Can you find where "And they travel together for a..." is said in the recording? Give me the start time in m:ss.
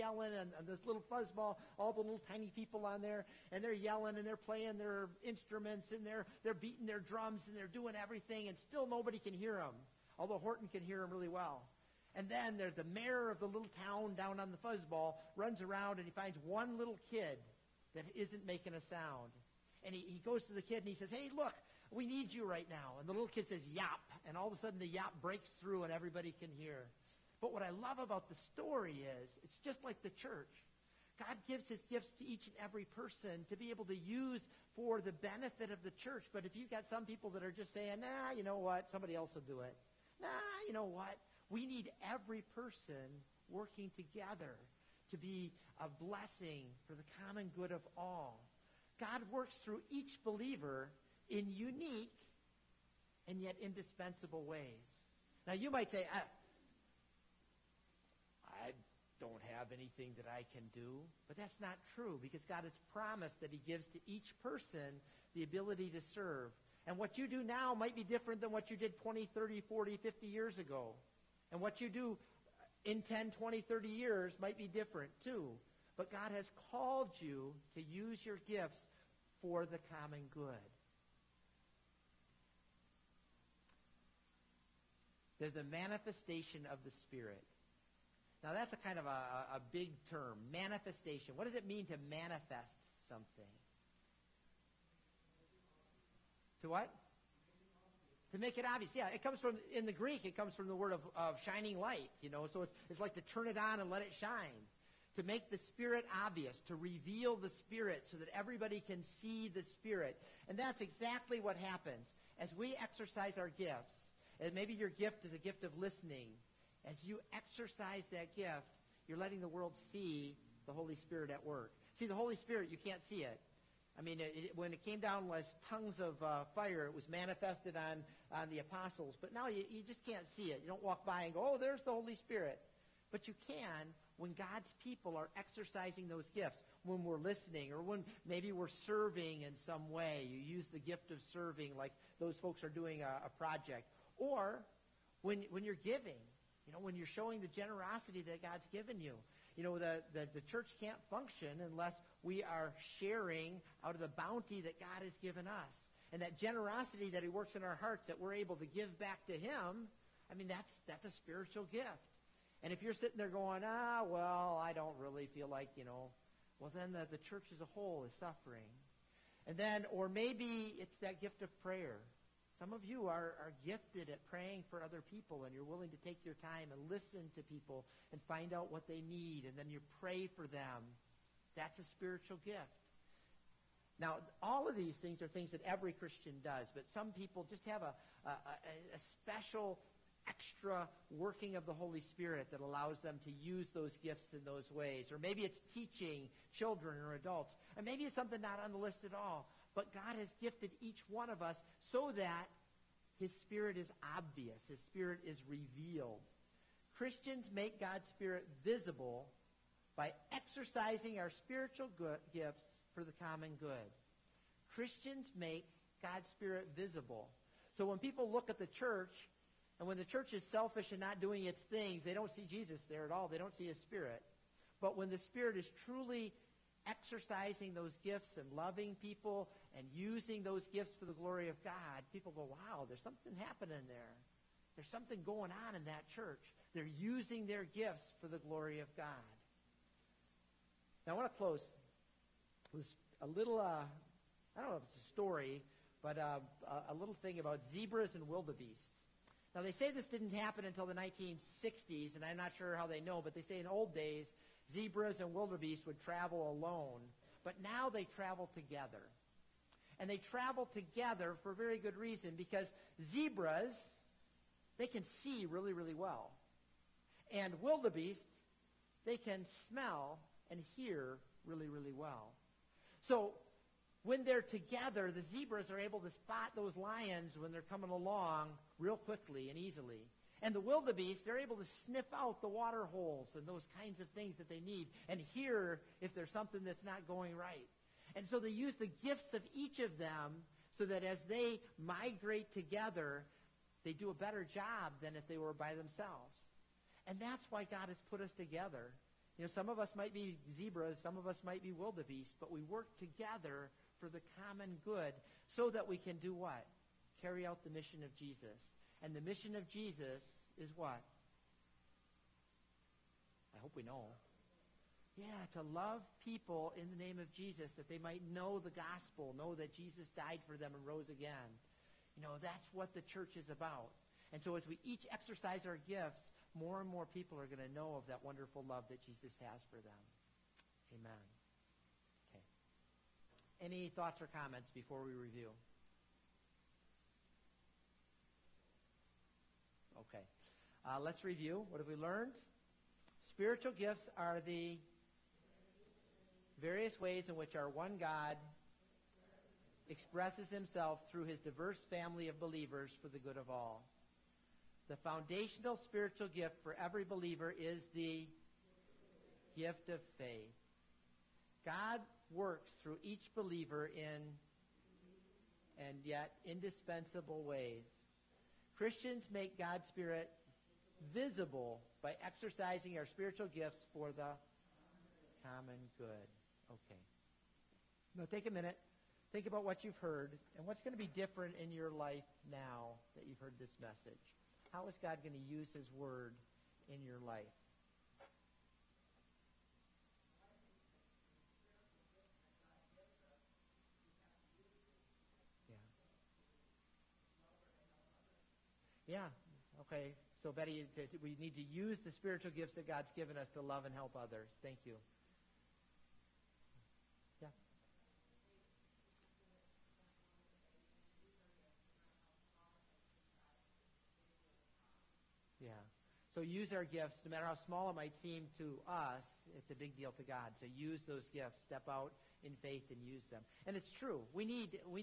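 4:20.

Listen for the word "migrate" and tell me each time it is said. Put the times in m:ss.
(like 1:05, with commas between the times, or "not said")
4:51.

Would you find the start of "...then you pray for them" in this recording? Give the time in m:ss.
2:59.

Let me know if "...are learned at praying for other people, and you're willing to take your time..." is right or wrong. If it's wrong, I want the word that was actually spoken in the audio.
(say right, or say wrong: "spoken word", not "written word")
wrong: "gifted", not "learned".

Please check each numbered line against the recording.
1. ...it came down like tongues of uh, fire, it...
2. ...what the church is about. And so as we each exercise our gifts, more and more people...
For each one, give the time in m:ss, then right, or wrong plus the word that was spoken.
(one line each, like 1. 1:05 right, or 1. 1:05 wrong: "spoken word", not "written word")
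1. 2:04 right
2. 5:22 right.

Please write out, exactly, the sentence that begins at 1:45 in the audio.
To make the Spirit obvious, to reveal the Spirit so that everybody can see the Spirit.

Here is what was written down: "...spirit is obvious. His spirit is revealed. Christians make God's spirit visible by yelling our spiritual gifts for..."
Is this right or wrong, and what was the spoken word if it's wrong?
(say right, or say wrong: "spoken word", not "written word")
wrong: "exercising", not "yelling".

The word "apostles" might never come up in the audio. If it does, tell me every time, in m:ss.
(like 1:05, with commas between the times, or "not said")
2:08.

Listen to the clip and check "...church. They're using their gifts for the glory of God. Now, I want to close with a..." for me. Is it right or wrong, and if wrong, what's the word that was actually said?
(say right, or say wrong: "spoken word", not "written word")
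right.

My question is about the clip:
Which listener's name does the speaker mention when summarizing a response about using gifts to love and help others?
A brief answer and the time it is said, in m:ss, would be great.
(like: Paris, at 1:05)
Betty, at 6:40.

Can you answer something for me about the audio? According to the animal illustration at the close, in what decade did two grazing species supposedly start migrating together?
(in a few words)
1960s.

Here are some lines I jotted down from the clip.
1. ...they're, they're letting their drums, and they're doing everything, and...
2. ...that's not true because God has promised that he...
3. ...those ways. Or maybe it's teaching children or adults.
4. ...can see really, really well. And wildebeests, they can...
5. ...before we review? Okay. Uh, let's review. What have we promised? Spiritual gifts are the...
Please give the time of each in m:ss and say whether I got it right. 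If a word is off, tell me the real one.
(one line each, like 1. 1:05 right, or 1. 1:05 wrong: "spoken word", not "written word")
1. 0:06 wrong: "beating", not "letting"
2. 1:01 right
3. 3:14 right
4. 4:24 right
5. 5:34 wrong: "learned", not "promised".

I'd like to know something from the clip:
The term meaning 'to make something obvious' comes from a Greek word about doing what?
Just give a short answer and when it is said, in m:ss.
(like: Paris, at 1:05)
Shining light, at 1:41.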